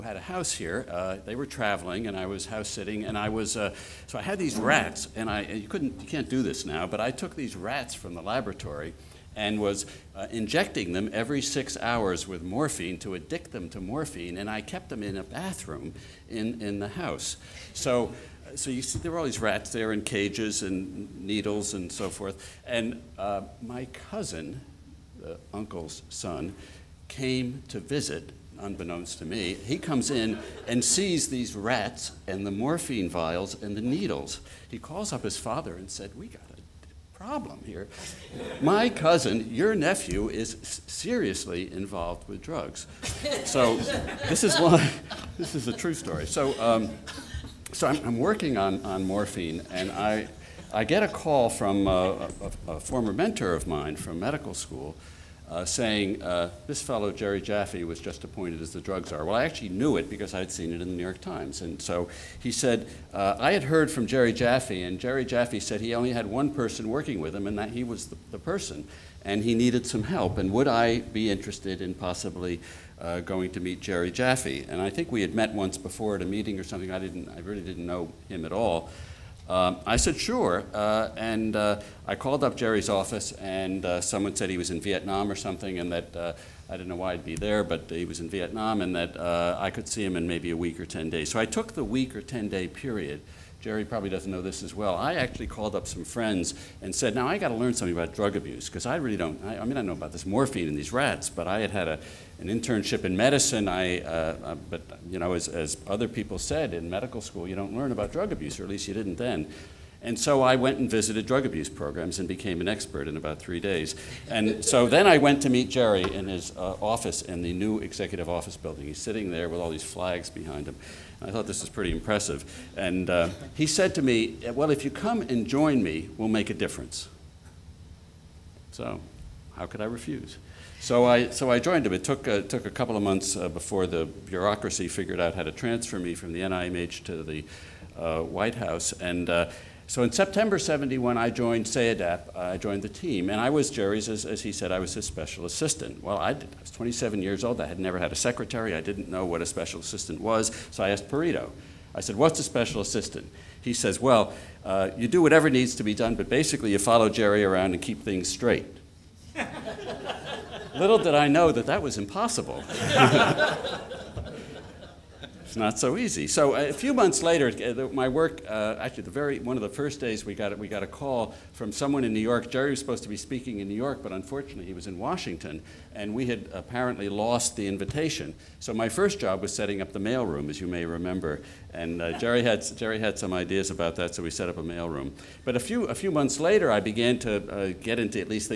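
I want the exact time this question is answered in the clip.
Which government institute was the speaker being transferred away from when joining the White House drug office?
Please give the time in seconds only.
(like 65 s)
136 s.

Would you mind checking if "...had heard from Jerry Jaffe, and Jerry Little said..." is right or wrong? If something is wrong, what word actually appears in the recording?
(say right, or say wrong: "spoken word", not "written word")
wrong: "Jaffe", not "Little".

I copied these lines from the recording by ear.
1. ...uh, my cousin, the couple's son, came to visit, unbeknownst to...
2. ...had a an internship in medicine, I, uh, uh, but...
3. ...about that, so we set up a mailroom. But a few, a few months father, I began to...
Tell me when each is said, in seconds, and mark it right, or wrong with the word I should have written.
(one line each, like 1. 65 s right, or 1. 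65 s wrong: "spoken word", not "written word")
1. 23 s wrong: "uncle", not "couple"
2. 101 s right
3. 183 s wrong: "later", not "father".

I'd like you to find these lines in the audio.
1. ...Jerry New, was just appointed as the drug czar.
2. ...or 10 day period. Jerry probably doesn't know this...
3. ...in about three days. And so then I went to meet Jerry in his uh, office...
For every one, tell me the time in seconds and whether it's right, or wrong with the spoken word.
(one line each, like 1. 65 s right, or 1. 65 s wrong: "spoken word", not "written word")
1. 57 s wrong: "Jaffe", not "New"
2. 92 s right
3. 113 s right.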